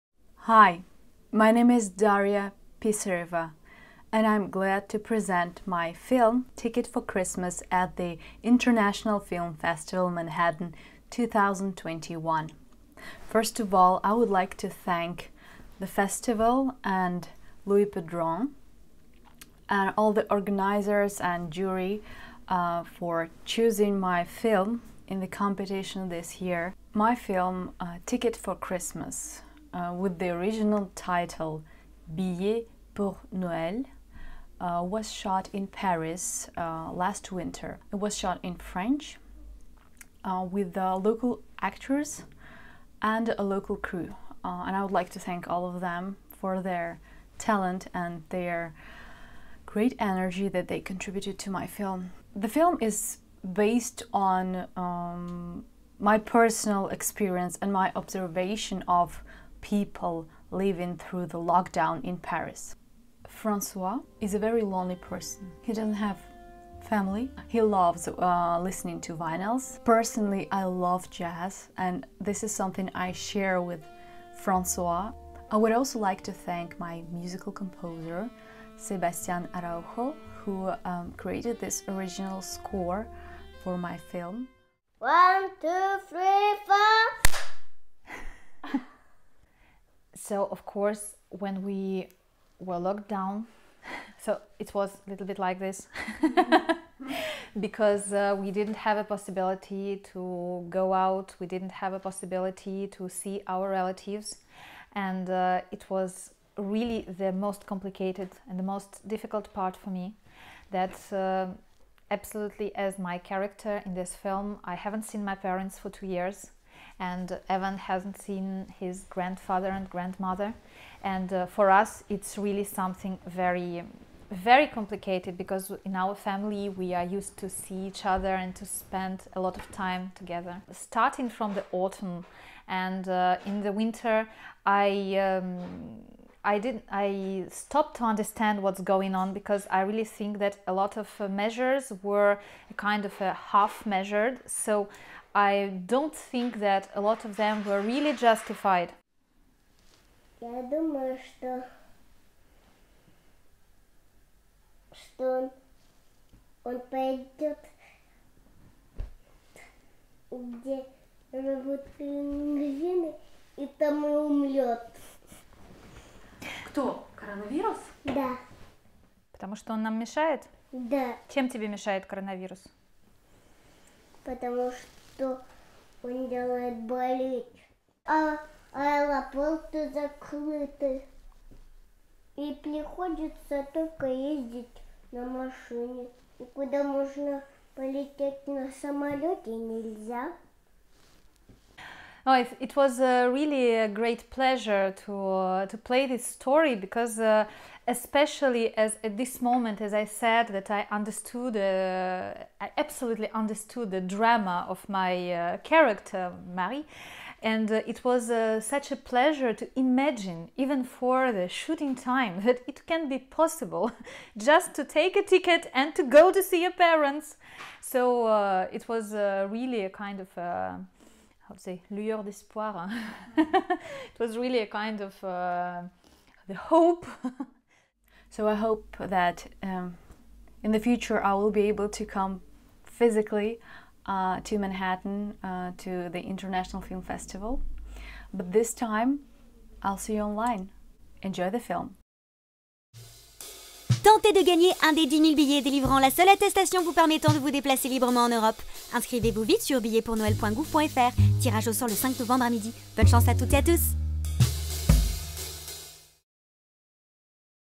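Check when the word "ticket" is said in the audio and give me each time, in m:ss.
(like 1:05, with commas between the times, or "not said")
0:06, 0:28, 3:35.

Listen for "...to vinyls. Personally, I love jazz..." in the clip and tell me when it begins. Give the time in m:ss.
1:09.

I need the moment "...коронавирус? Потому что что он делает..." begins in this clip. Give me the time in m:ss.
2:52.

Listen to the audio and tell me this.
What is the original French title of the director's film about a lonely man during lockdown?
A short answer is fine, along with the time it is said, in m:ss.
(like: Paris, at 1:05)
Billet pour Noël, at 0:32.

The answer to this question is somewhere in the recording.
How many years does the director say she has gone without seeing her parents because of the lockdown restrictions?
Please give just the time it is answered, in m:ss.
1:55.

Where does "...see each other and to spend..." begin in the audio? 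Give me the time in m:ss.
2:07.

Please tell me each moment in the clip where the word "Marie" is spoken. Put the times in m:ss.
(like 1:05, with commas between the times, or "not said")
3:26.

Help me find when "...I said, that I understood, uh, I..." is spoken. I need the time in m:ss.
3:19.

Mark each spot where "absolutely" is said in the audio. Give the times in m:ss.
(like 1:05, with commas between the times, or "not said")
1:52, 3:22.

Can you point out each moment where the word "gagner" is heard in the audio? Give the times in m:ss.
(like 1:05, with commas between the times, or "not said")
4:04.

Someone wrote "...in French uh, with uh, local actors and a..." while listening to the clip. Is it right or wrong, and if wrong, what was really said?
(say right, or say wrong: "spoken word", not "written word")
right.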